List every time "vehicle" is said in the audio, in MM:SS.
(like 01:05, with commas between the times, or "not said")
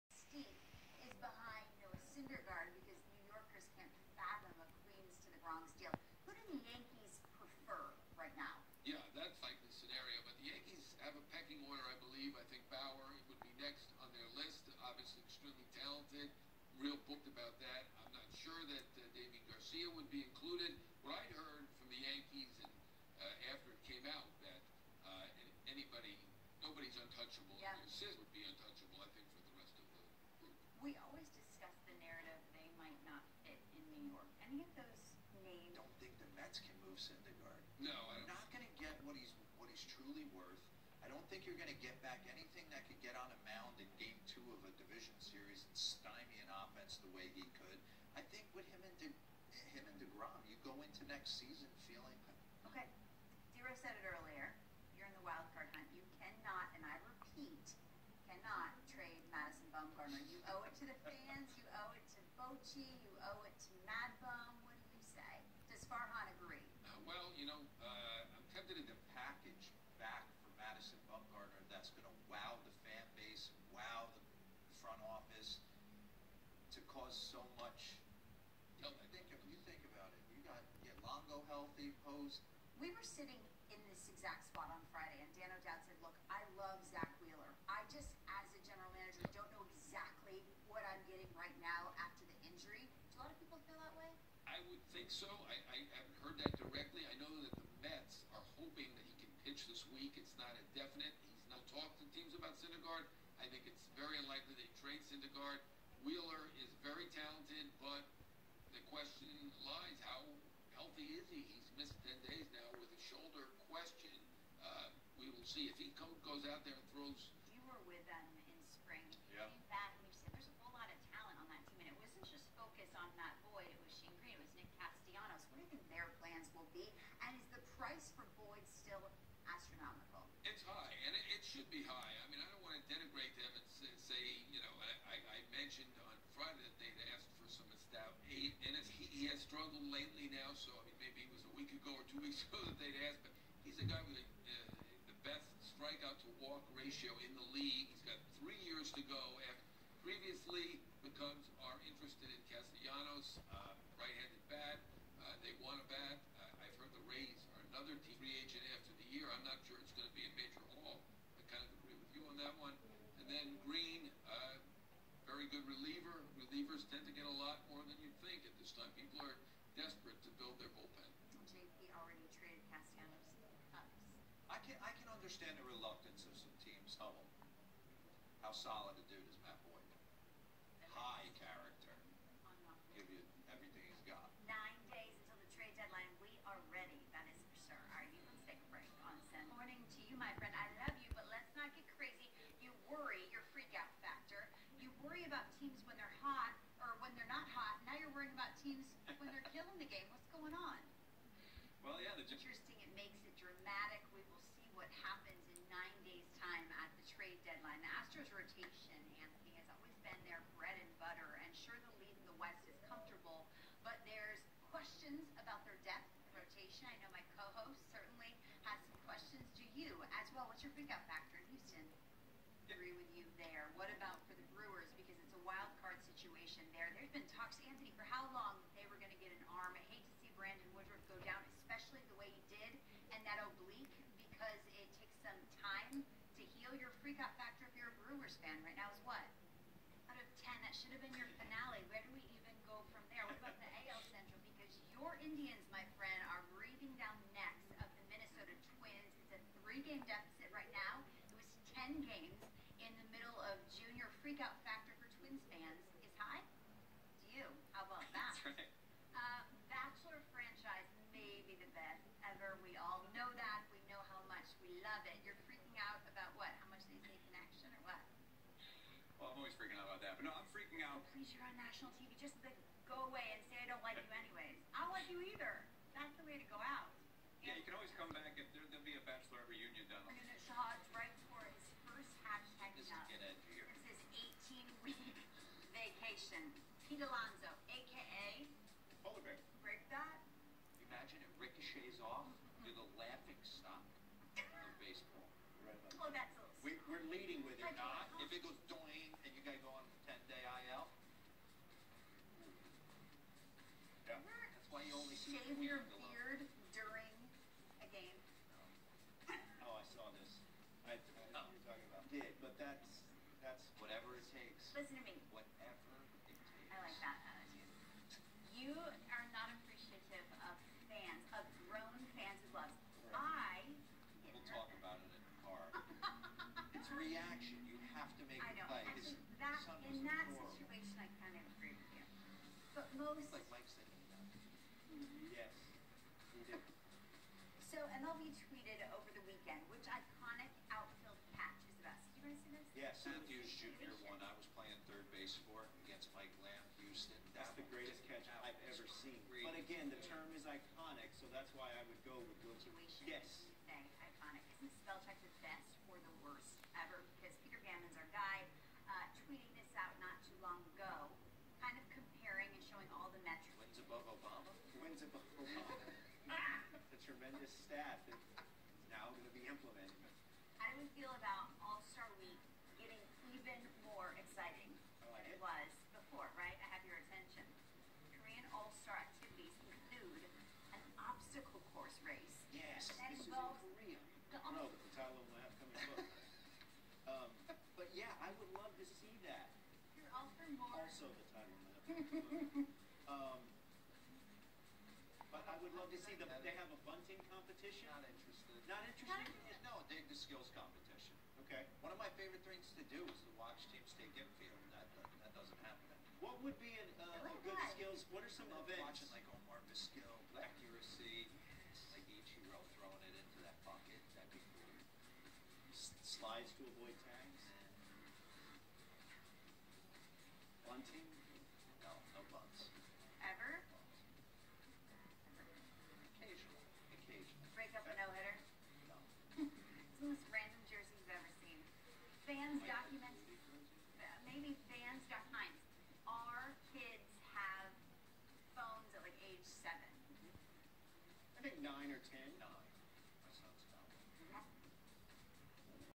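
not said.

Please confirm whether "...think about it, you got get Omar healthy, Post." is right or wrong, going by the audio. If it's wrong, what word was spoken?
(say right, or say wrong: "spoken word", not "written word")
wrong: "Longo", not "Omar".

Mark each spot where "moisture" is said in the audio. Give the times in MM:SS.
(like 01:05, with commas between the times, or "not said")
not said.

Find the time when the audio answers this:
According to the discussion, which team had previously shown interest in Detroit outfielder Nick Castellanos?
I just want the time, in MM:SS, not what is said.
02:31.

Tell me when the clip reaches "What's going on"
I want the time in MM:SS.
03:20.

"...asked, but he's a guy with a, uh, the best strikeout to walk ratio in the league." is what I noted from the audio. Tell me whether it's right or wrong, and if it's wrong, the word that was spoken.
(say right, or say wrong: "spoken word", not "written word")
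right.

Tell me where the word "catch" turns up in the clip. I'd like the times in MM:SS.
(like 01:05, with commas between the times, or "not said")
05:41, 05:48.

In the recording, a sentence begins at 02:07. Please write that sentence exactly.
And is the price for Boyd still astronomical?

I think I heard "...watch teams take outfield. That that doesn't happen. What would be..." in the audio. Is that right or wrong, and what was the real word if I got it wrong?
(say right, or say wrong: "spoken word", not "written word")
wrong: "infield", not "outfield".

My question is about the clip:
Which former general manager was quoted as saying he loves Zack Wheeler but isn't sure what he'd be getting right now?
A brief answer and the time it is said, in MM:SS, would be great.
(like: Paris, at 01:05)
Dan O'Dowd, at 01:25.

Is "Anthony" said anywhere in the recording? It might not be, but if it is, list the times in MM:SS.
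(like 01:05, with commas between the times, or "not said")
03:29, 03:47.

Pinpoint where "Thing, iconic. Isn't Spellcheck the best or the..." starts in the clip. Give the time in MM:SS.
05:53.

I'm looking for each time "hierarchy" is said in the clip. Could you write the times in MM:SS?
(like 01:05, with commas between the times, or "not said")
not said.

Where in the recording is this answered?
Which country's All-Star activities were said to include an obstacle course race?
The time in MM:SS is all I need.
06:18.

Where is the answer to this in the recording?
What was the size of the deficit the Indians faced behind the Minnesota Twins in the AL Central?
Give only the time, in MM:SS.
04:09.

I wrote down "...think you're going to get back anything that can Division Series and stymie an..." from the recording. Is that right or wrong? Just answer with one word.
right.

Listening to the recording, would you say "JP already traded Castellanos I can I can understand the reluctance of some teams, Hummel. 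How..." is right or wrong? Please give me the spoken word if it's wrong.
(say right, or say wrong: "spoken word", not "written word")
right.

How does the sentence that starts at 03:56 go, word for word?
Your freak-out factor if you're a Brewers fan right now is what?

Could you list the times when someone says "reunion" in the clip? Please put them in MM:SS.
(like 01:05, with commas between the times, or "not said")
04:39.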